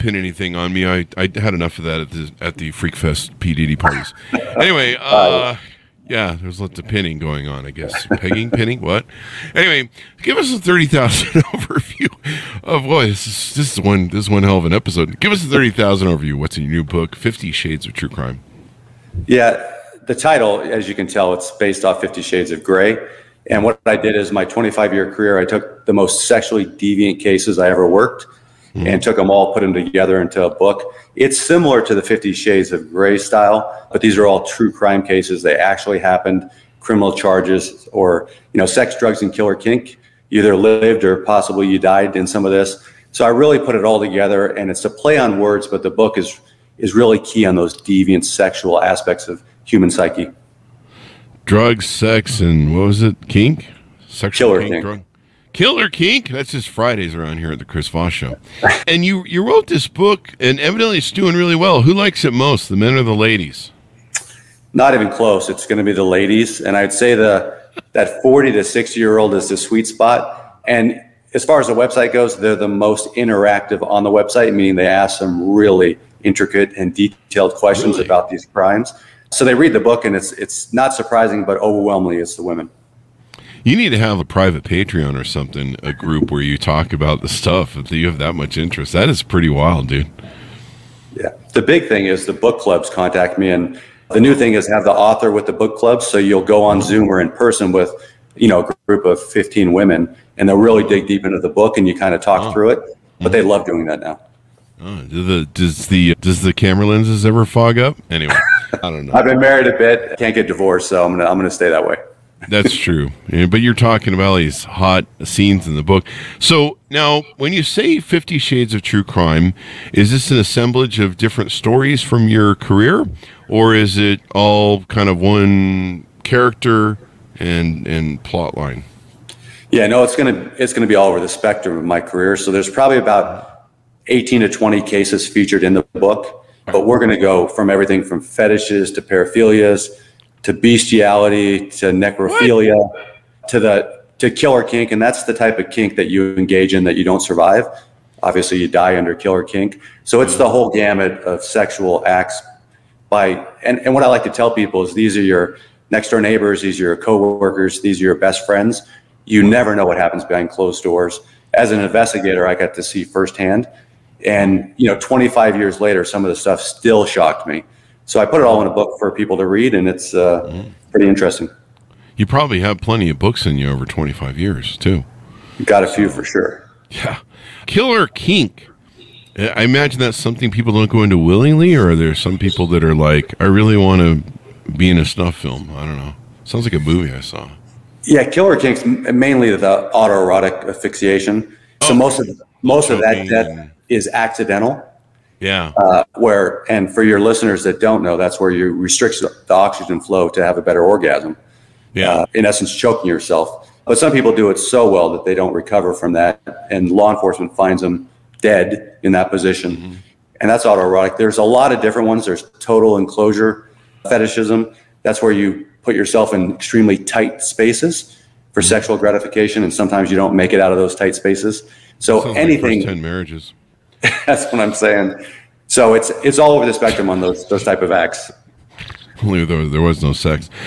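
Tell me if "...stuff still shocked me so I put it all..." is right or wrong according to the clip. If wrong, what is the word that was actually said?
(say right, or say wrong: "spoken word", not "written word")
right.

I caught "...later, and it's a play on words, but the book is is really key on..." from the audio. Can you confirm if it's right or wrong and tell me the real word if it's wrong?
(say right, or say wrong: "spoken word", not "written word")
wrong: "together", not "later".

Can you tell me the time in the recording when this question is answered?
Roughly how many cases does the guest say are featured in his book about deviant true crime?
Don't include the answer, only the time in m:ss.
2:14.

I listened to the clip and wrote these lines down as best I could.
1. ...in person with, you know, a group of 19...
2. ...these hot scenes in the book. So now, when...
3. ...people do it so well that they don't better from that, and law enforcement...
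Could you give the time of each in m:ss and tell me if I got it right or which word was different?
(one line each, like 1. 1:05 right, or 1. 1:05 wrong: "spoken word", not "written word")
1. 1:37 wrong: "15", not "19"
2. 1:54 right
3. 3:24 wrong: "recover", not "better".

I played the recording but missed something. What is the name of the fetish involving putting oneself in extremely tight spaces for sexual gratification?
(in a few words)
Total enclosure fetishism.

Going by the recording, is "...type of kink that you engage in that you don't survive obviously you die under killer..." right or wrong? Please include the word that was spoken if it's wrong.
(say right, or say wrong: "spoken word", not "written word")
right.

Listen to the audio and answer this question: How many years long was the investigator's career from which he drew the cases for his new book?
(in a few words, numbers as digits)
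25.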